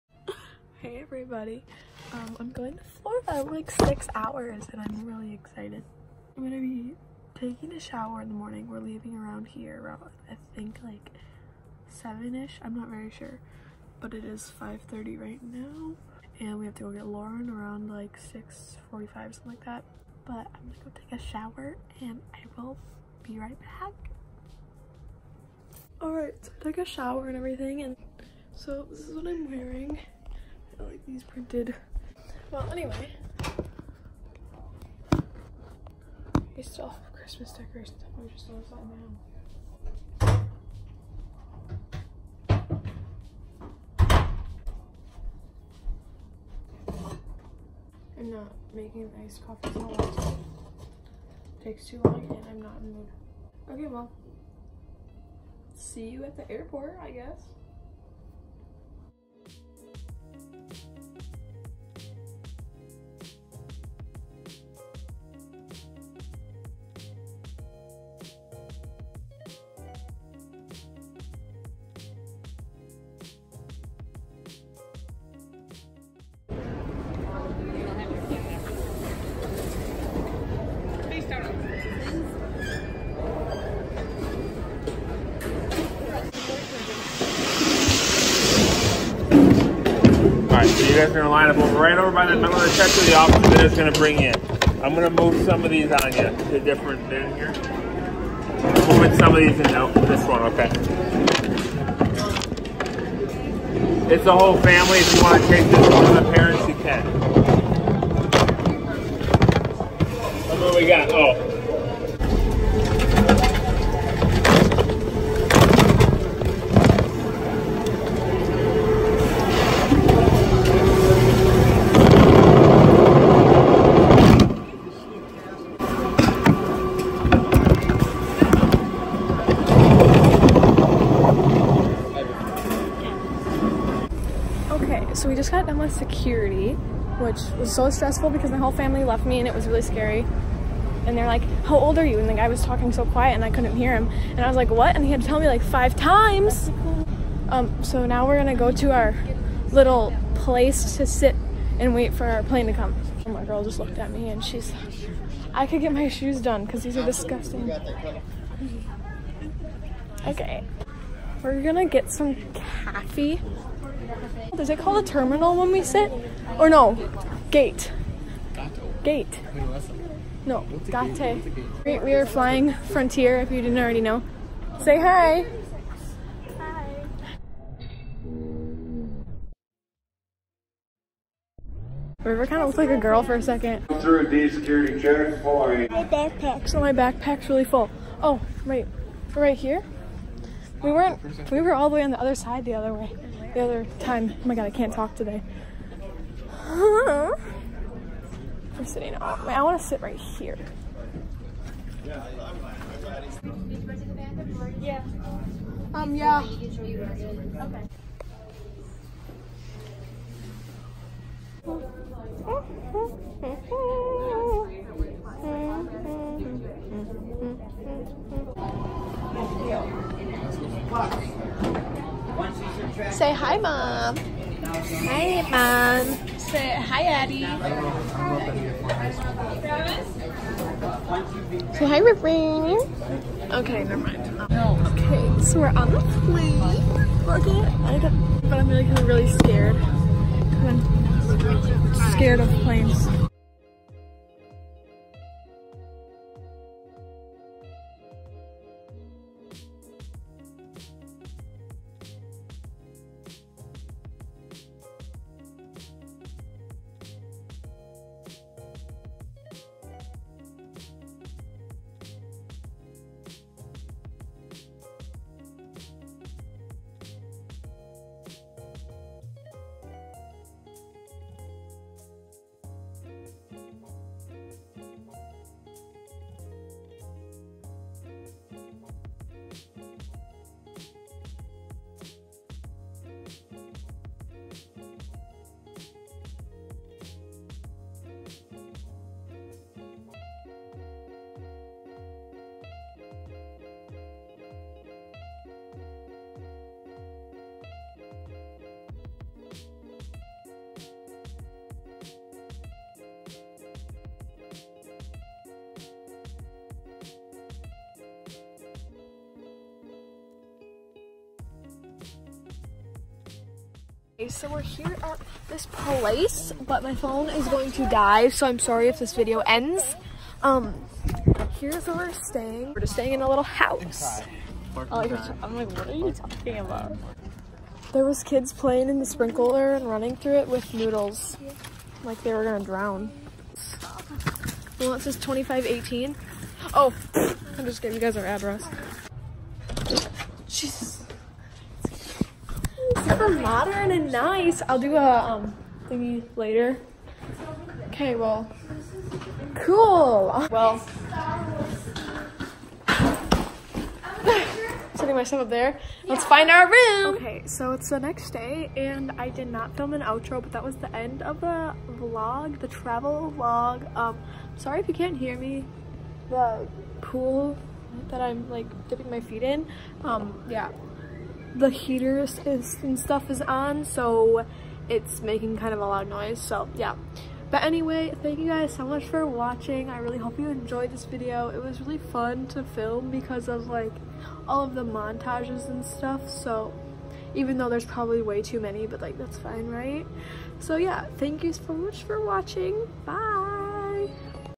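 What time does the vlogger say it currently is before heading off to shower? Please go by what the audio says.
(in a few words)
5:30.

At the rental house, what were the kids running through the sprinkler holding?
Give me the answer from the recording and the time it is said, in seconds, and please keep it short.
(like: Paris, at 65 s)
noodles, at 330 s.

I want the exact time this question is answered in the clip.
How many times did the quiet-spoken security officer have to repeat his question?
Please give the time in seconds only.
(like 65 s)
145 s.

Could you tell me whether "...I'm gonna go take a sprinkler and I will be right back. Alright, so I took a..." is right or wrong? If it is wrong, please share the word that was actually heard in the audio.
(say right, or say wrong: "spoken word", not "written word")
wrong: "shower", not "sprinkler".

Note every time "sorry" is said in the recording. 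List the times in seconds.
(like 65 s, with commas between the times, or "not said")
318 s, 364 s.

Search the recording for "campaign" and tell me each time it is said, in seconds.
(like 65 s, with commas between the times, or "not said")
not said.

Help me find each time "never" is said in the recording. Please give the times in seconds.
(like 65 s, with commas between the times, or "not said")
233 s.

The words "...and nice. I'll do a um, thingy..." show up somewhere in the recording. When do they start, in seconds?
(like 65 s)
343 s.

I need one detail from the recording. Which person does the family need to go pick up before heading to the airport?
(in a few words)
Lauren.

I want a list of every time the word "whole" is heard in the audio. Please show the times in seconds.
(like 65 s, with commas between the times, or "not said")
104 s, 138 s.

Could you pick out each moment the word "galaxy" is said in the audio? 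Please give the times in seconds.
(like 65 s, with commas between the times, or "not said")
not said.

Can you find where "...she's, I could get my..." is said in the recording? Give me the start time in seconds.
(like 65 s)
154 s.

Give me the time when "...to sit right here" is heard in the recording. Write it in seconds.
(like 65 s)
199 s.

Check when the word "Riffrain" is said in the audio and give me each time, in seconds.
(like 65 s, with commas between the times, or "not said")
232 s.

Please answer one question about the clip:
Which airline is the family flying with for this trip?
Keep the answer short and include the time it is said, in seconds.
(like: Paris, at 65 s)
Frontier, at 172 s.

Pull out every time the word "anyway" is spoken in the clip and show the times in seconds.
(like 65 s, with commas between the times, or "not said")
32 s, 377 s.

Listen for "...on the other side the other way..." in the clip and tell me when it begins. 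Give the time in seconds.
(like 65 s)
192 s.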